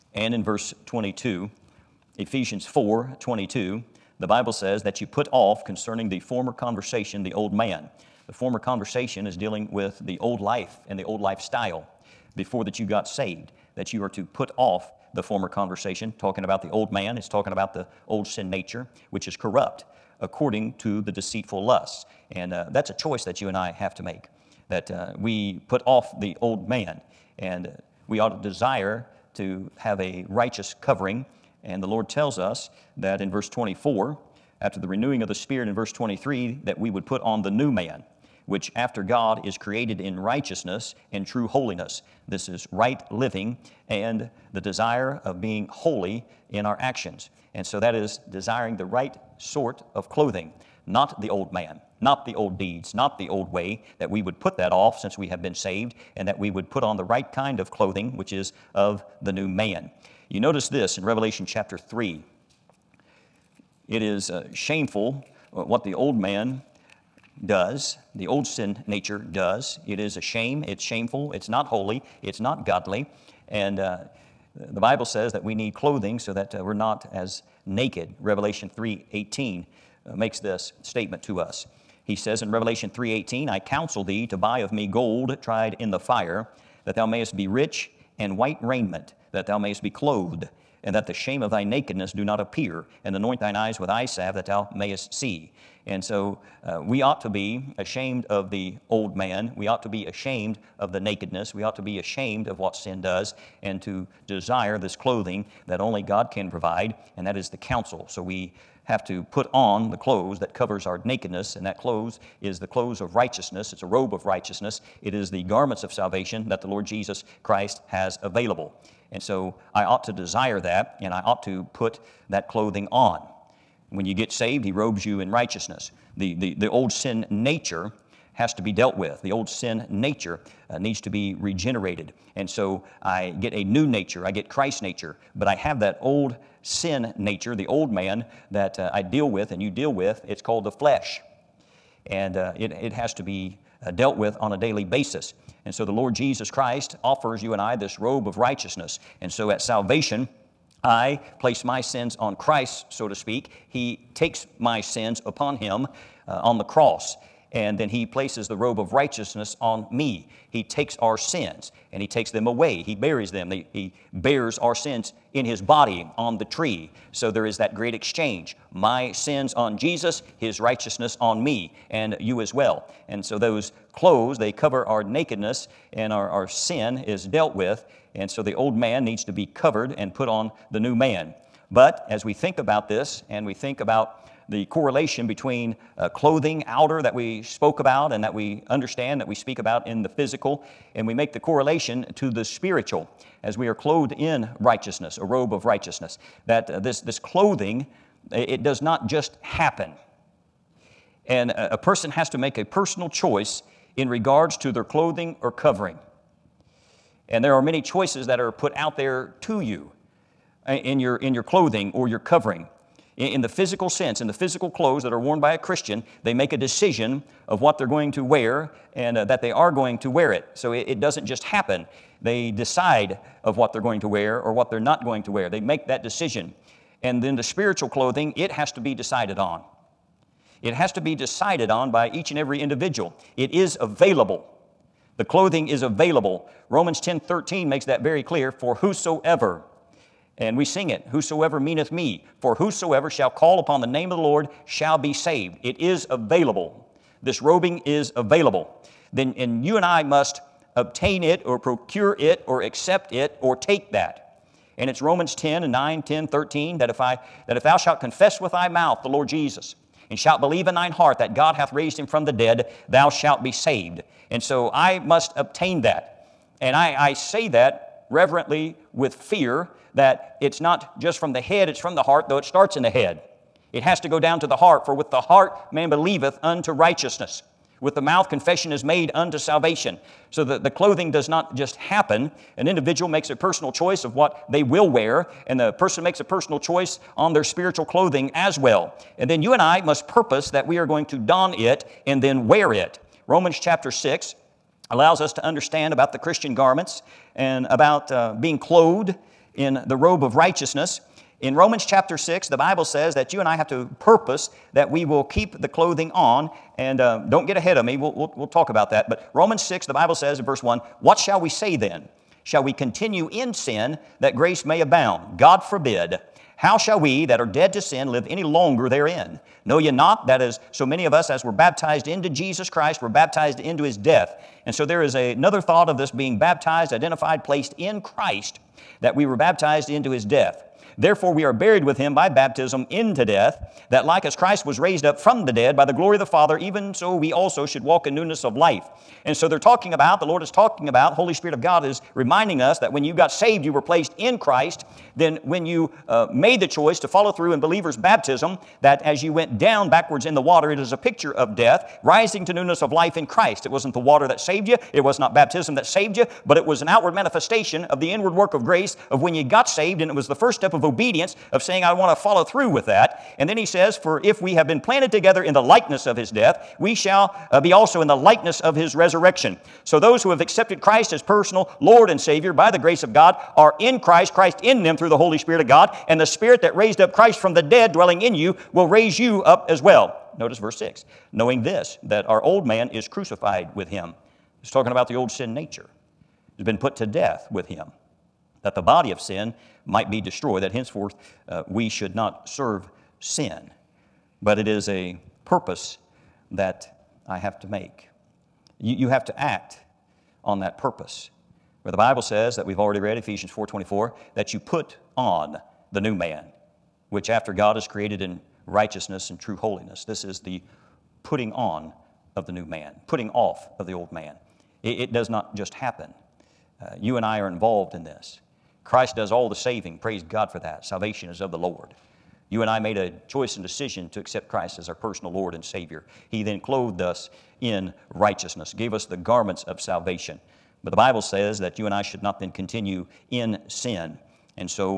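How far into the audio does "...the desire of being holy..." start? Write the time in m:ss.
0:44.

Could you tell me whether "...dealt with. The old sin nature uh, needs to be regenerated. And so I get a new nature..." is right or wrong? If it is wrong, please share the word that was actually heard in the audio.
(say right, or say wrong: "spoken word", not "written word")
right.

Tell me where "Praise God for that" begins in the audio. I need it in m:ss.
6:59.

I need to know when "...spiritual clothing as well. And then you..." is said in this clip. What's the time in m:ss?
4:47.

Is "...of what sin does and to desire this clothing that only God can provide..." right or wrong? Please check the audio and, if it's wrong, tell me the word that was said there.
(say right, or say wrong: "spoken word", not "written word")
right.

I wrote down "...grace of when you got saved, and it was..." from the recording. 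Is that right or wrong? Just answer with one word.
right.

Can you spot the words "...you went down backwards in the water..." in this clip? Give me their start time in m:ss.
5:49.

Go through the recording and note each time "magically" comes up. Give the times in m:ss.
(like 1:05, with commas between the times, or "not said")
not said.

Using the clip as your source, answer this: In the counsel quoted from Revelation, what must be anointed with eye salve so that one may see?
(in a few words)
thine eyes.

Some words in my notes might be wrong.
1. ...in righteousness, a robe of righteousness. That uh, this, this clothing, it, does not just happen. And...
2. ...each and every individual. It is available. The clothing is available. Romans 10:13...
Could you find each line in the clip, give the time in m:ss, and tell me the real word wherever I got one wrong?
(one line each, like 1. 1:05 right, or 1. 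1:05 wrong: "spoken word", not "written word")
1. 3:14 right
2. 3:52 right.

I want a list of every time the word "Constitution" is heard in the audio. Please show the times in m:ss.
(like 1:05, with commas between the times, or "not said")
not said.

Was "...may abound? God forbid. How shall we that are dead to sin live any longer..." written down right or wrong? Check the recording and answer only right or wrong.
right.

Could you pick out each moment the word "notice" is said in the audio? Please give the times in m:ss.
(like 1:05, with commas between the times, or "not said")
1:00, 6:20.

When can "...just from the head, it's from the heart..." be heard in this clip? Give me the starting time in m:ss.
4:30.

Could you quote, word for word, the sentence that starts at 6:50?
This is the putting on of the new man, putting off of the old man.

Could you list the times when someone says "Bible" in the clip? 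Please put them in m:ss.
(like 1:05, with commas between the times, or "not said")
0:04, 1:14, 5:02, 5:09, 6:41, 7:10.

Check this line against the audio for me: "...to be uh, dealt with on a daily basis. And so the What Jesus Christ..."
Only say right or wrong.
wrong.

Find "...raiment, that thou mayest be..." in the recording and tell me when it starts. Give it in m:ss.
1:28.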